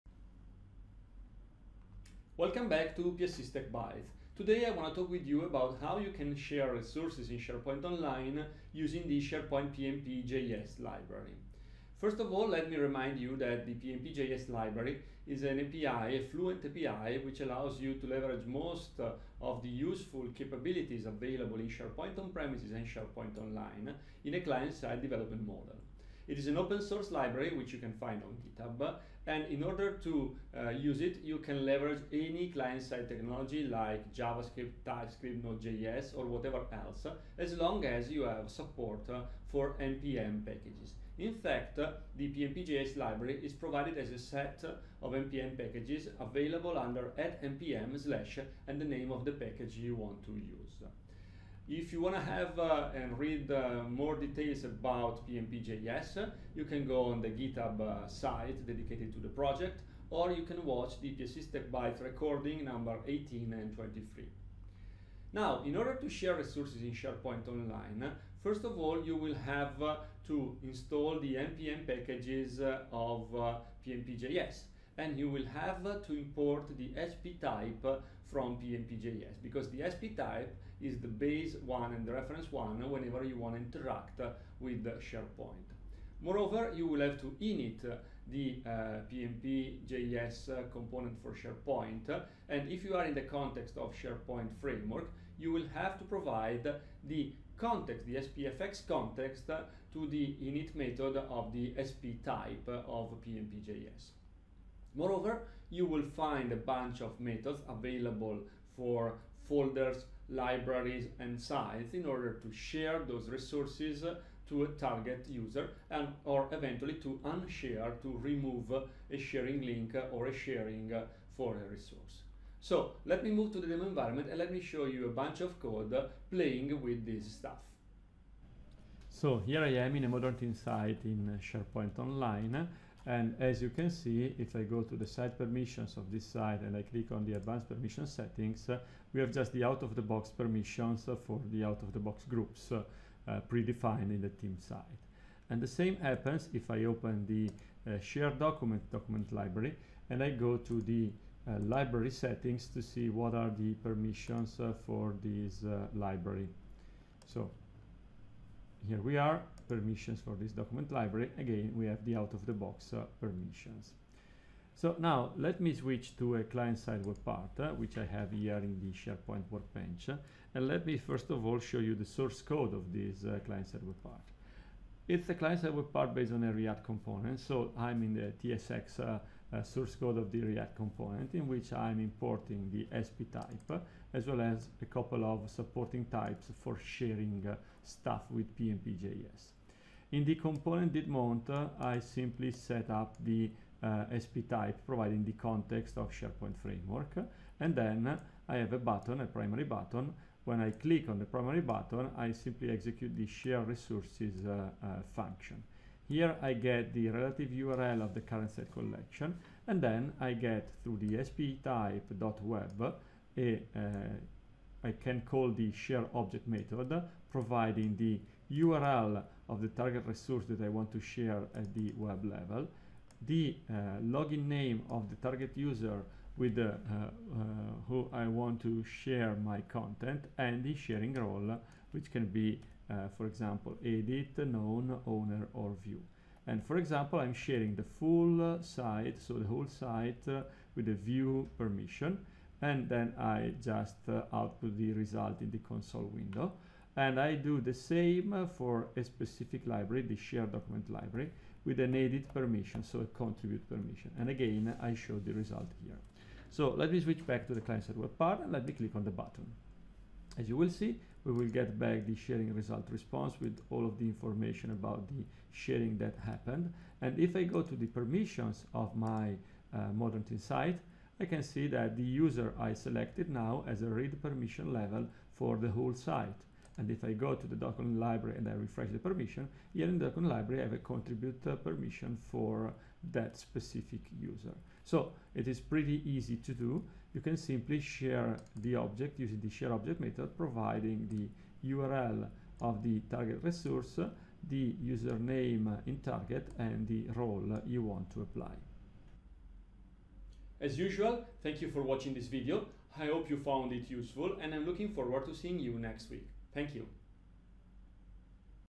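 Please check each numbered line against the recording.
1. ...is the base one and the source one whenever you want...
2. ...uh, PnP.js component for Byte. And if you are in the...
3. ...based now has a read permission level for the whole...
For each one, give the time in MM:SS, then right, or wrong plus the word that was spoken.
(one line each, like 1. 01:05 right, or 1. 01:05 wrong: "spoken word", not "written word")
1. 01:20 wrong: "reference", not "source"
2. 01:28 wrong: "SharePoint", not "Byte"
3. 04:32 wrong: "selected", not "based".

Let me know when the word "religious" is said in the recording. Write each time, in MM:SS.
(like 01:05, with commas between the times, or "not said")
not said.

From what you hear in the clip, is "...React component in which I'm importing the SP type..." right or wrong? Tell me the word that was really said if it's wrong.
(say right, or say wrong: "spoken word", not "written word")
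right.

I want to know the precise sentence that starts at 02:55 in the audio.
It's a client-side web part based on a React component.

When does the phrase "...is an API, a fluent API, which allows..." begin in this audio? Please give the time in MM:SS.
00:15.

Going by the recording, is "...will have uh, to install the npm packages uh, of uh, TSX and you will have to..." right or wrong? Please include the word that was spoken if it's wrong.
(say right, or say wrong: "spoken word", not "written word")
wrong: "PnPJS", not "TSX".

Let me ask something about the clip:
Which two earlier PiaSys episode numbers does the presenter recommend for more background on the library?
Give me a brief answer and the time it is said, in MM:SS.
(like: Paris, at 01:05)
18 and 23, at 01:02.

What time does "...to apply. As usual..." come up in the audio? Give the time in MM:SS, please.
04:58.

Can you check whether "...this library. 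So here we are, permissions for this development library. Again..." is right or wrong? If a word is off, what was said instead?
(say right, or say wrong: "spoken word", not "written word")
wrong: "document", not "development".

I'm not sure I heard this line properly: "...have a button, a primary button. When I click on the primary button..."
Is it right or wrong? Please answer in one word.
right.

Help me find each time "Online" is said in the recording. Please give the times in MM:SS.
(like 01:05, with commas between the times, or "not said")
00:07, 00:23, 01:07, 02:11.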